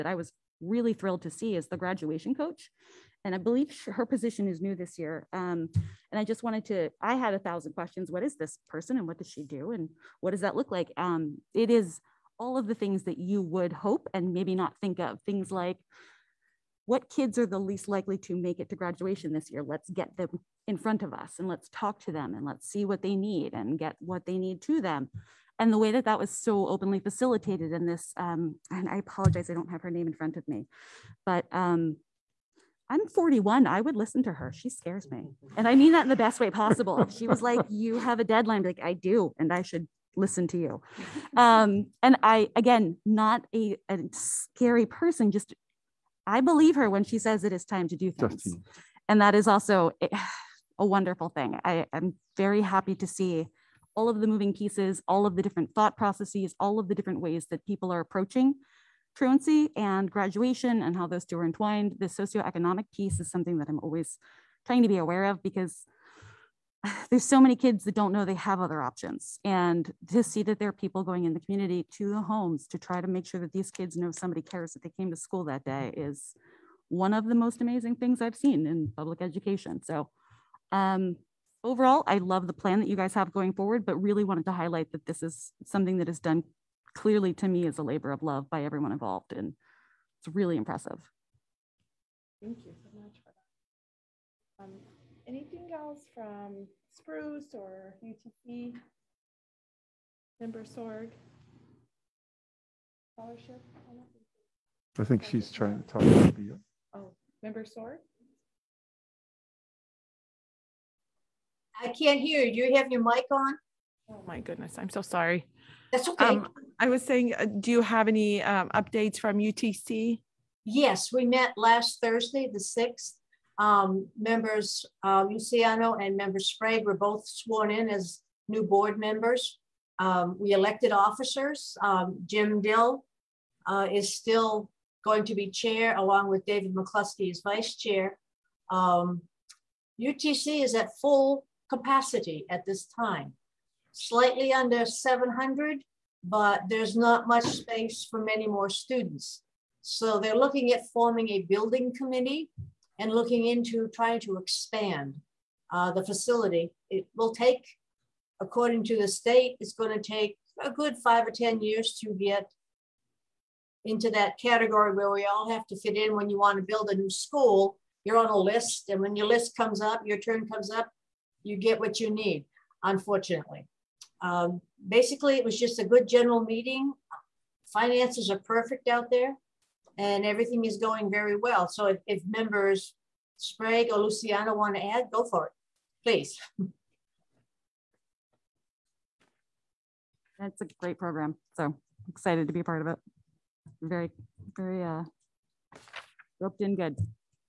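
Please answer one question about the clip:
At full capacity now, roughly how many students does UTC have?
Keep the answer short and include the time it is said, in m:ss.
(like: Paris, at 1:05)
700, at 2:24.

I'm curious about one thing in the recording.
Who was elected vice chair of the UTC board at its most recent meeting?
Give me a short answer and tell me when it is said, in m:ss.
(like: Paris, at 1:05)
David McCluskey, at 2:16.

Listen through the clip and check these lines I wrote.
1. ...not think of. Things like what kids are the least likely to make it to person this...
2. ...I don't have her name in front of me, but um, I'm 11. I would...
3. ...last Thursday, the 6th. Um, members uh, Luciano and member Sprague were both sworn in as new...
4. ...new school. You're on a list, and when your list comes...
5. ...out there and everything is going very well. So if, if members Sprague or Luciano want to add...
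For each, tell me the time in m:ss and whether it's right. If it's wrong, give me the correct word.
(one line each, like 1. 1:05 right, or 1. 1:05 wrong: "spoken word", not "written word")
1. 0:14 wrong: "graduation", not "person"
2. 0:29 wrong: "41", not "11"
3. 2:01 right
4. 2:46 right
5. 2:58 right.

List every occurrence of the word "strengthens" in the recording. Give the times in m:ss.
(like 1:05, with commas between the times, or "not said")
not said.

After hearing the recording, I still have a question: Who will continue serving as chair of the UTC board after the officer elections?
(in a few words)
Jim Dill.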